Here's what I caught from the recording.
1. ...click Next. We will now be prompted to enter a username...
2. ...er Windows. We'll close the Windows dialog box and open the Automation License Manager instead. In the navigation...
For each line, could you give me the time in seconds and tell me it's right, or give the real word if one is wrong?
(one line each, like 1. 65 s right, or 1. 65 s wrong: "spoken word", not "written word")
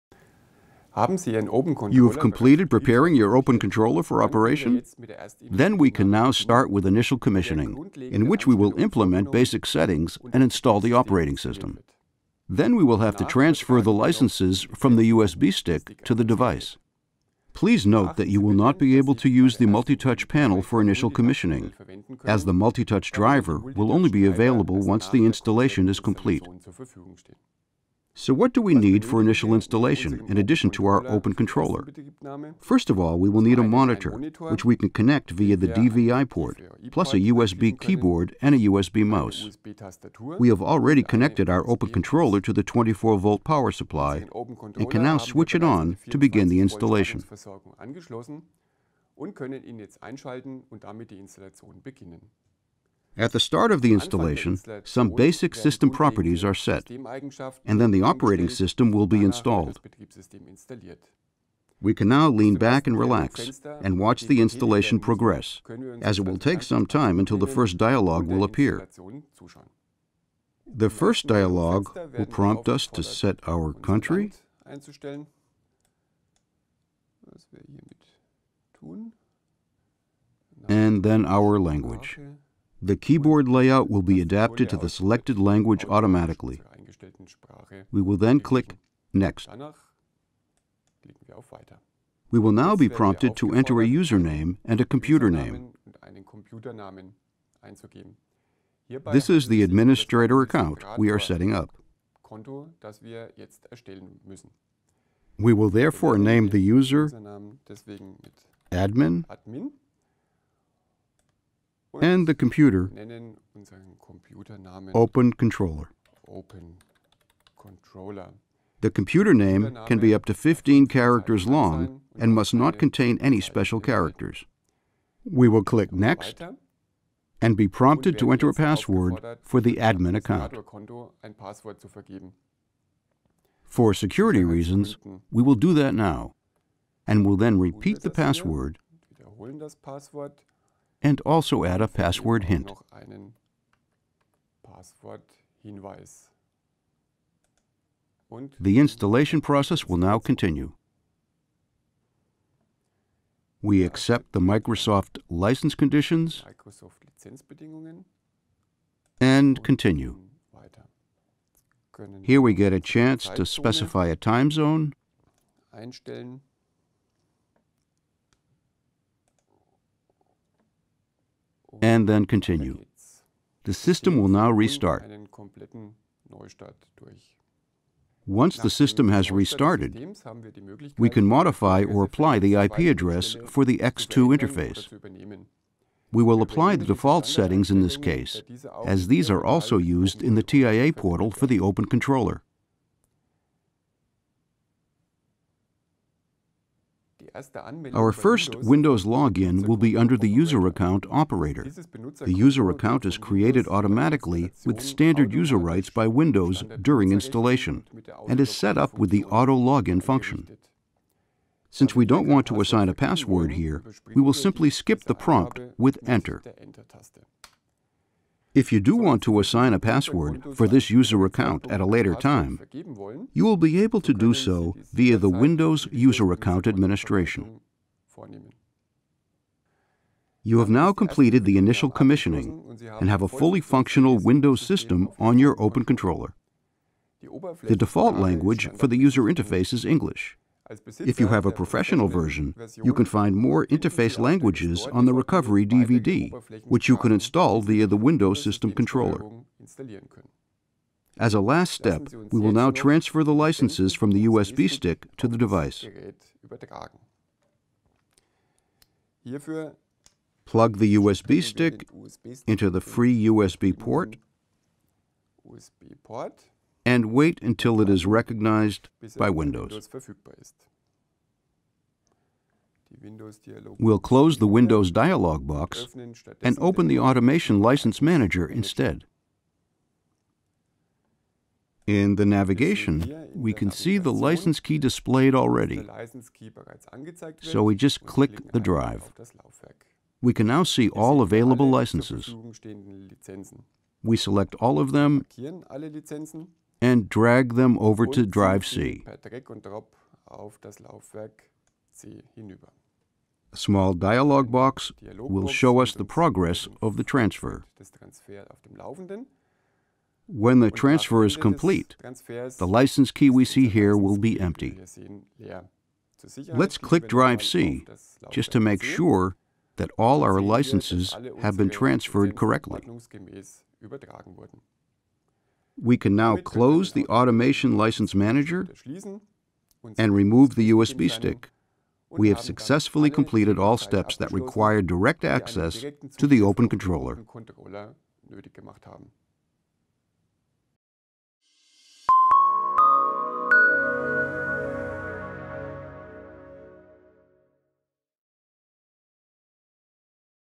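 1. 88 s right
2. 269 s right.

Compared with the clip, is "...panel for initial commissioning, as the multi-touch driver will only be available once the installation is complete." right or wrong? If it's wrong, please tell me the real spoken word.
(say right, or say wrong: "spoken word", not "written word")
right.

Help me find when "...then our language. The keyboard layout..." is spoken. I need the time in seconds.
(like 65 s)
81 s.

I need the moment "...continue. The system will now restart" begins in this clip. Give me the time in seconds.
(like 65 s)
172 s.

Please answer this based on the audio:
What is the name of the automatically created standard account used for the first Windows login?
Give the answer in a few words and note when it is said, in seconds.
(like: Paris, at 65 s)
operator, at 201 s.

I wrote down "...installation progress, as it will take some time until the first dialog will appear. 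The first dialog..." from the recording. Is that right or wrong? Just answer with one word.
right.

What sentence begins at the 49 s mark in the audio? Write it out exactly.
und können ihn jetzt einschalten und damit die Installation beginnen.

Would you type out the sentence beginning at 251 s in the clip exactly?
As a last step, we will now transfer the licenses from the USB stick to the device.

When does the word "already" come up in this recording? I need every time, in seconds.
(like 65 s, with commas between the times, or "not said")
40 s, 285 s.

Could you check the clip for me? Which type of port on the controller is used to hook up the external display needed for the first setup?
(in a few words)
DVI.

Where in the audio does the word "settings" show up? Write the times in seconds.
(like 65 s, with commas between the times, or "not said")
9 s, 101 s, 187 s.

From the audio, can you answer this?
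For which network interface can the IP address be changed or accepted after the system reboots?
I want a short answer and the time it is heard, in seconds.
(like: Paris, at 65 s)
X2, at 183 s.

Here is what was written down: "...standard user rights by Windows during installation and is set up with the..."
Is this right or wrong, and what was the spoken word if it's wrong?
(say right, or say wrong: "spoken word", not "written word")
right.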